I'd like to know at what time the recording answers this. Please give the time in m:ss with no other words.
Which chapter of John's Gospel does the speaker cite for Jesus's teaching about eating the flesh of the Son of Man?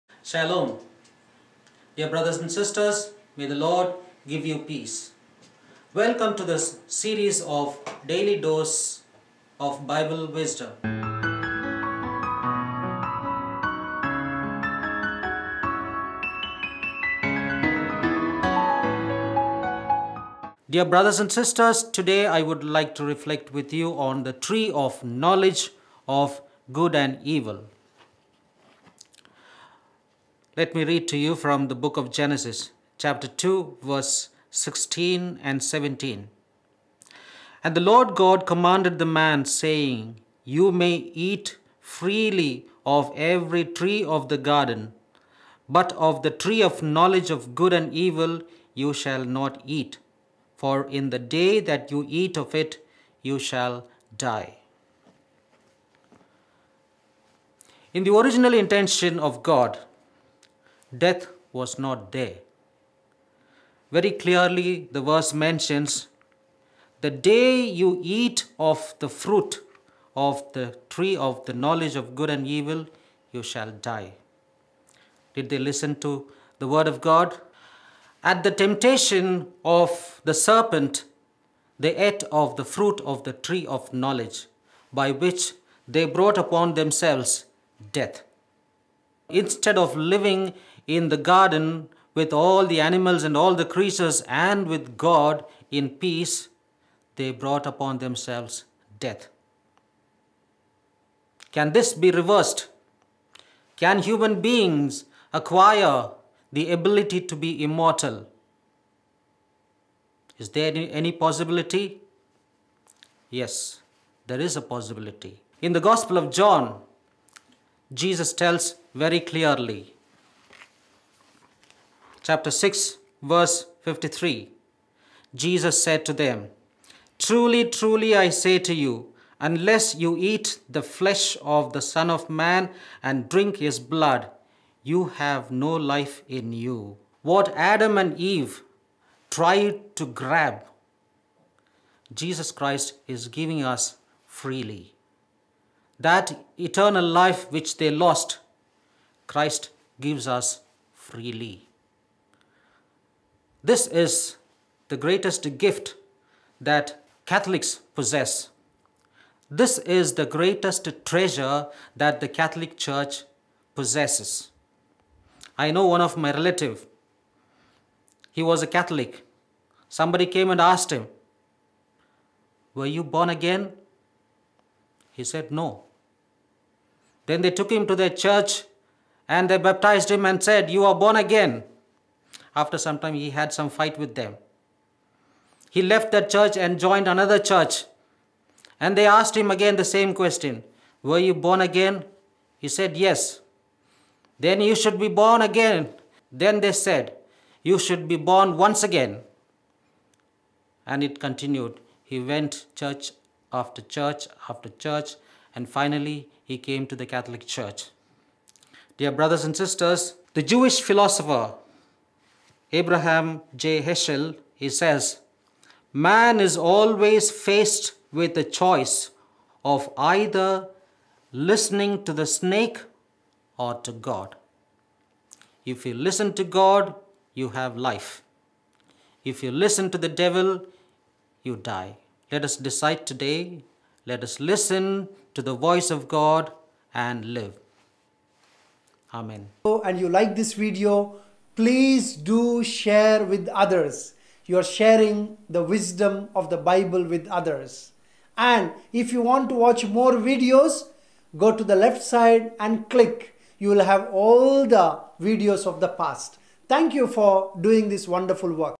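2:02.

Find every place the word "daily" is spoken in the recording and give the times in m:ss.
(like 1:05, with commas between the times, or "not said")
0:08.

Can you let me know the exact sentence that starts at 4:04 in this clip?
You are sharing the wisdom of the Bible with others.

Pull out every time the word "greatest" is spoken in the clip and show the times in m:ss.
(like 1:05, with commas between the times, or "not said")
2:34, 2:40.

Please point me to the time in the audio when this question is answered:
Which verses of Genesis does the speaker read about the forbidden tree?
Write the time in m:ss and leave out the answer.
0:33.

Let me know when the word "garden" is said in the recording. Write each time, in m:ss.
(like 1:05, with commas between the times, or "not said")
0:44, 1:31.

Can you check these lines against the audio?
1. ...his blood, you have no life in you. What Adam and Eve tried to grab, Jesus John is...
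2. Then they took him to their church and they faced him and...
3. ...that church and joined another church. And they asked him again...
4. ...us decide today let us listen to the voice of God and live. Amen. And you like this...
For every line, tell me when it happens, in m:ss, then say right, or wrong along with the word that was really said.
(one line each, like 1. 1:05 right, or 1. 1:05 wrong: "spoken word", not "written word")
1. 2:13 wrong: "Christ", not "John"
2. 2:57 wrong: "baptized", not "faced"
3. 3:06 right
4. 3:52 right.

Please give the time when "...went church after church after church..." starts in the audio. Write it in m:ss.
3:22.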